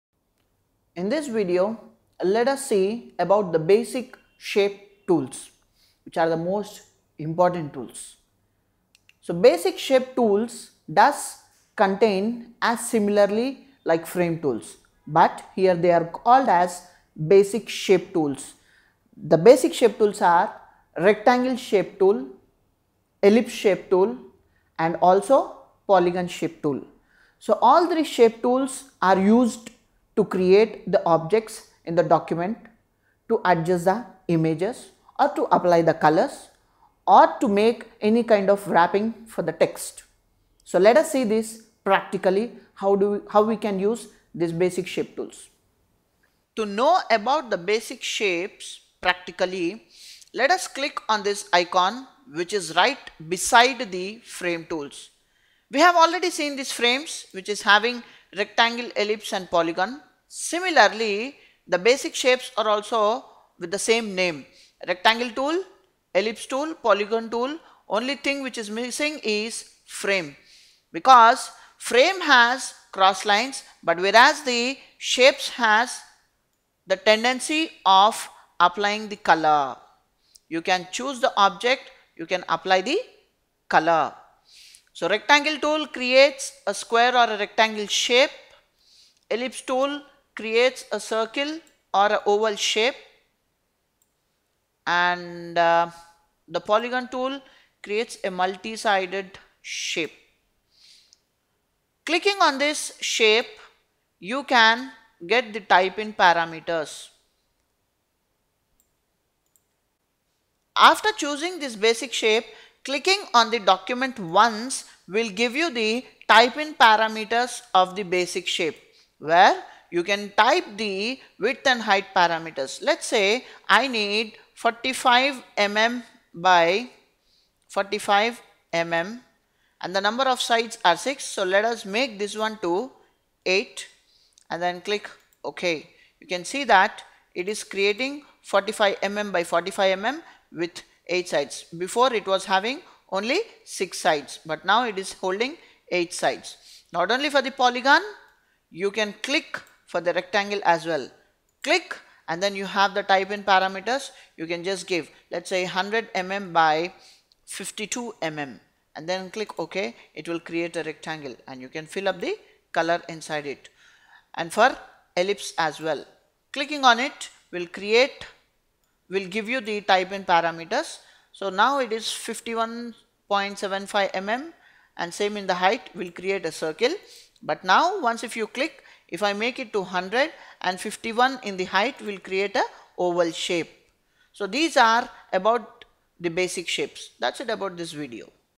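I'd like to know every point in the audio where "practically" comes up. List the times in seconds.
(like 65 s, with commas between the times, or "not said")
41 s, 49 s.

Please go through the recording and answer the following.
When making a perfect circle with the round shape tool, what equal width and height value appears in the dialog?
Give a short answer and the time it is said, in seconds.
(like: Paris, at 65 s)
51.75 mm, at 172 s.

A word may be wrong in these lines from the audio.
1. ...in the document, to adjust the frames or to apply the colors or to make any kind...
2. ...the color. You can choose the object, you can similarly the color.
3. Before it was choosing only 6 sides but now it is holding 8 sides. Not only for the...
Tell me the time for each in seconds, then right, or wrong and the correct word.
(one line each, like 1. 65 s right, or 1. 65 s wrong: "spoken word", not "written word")
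1. 31 s wrong: "images", not "frames"
2. 79 s wrong: "apply", not "similarly"
3. 141 s wrong: "having", not "choosing".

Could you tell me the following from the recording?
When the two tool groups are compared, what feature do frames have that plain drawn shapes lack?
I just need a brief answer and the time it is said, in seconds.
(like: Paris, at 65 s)
cross lines, at 72 s.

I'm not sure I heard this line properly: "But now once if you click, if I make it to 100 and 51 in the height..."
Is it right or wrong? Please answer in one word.
right.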